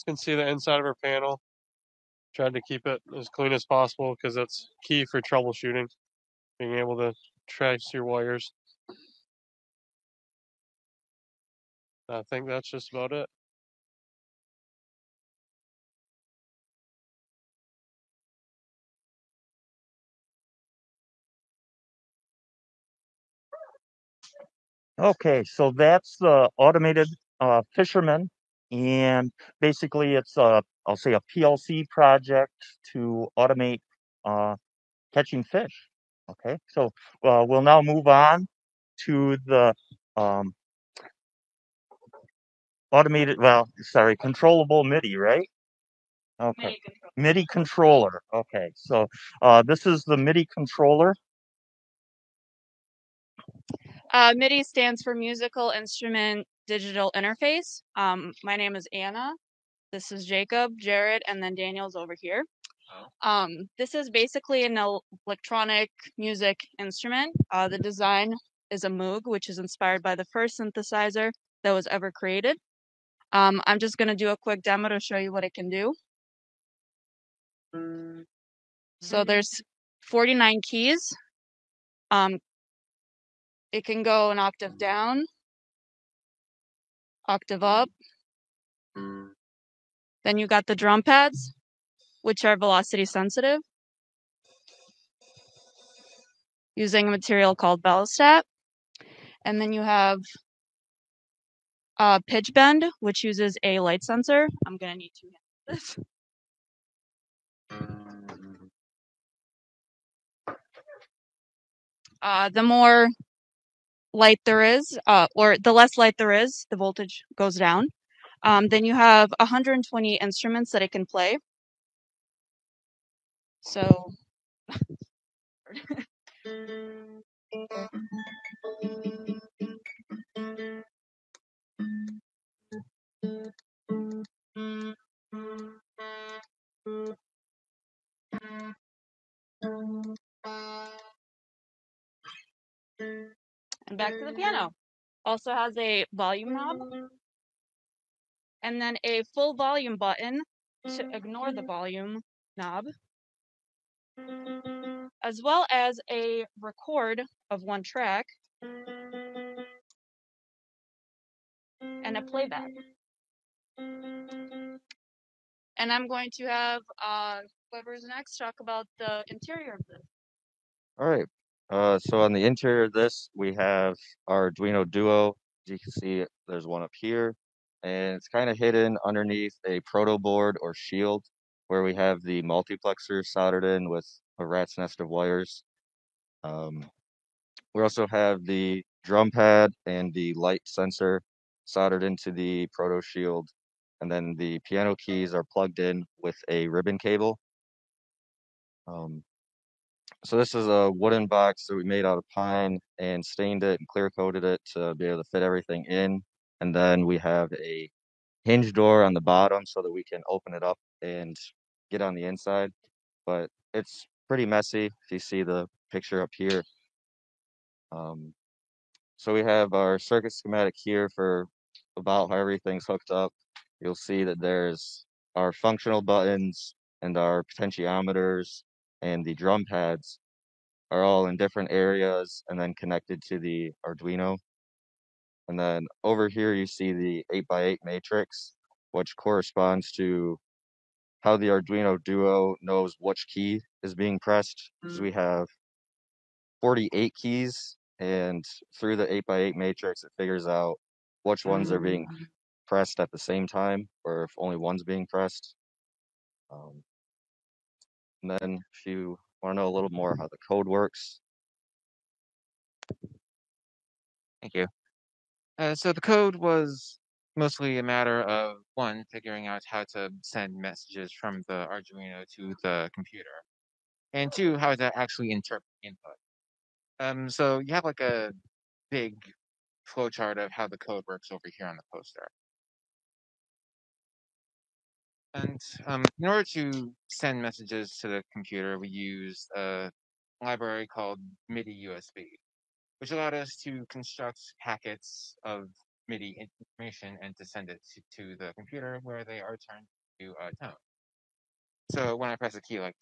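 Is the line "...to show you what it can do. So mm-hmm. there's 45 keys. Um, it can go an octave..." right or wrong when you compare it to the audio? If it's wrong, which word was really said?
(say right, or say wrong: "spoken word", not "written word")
wrong: "49", not "45".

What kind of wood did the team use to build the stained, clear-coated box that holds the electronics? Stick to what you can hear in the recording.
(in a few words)
Pine.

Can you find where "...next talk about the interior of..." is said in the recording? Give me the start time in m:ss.
2:48.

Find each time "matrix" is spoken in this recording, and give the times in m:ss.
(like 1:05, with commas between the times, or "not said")
3:57, 4:09.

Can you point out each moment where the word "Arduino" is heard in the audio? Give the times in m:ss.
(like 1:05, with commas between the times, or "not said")
2:54, 3:53, 4:01, 4:31.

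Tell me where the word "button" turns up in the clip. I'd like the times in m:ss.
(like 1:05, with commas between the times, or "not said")
2:29, 3:46.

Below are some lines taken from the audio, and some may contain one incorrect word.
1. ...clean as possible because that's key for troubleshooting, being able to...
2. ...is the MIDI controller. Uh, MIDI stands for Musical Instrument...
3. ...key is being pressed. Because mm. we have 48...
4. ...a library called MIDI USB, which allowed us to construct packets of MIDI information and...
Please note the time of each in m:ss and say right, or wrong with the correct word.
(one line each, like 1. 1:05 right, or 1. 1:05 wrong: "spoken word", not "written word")
1. 0:03 right
2. 0:49 right
3. 4:03 right
4. 4:49 right.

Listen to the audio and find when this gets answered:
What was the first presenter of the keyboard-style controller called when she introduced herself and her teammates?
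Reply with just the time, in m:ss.
0:58.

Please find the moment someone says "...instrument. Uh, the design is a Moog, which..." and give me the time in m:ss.
1:06.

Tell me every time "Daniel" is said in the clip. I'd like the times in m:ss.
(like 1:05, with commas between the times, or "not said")
1:01.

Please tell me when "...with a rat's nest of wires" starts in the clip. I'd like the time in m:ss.
3:03.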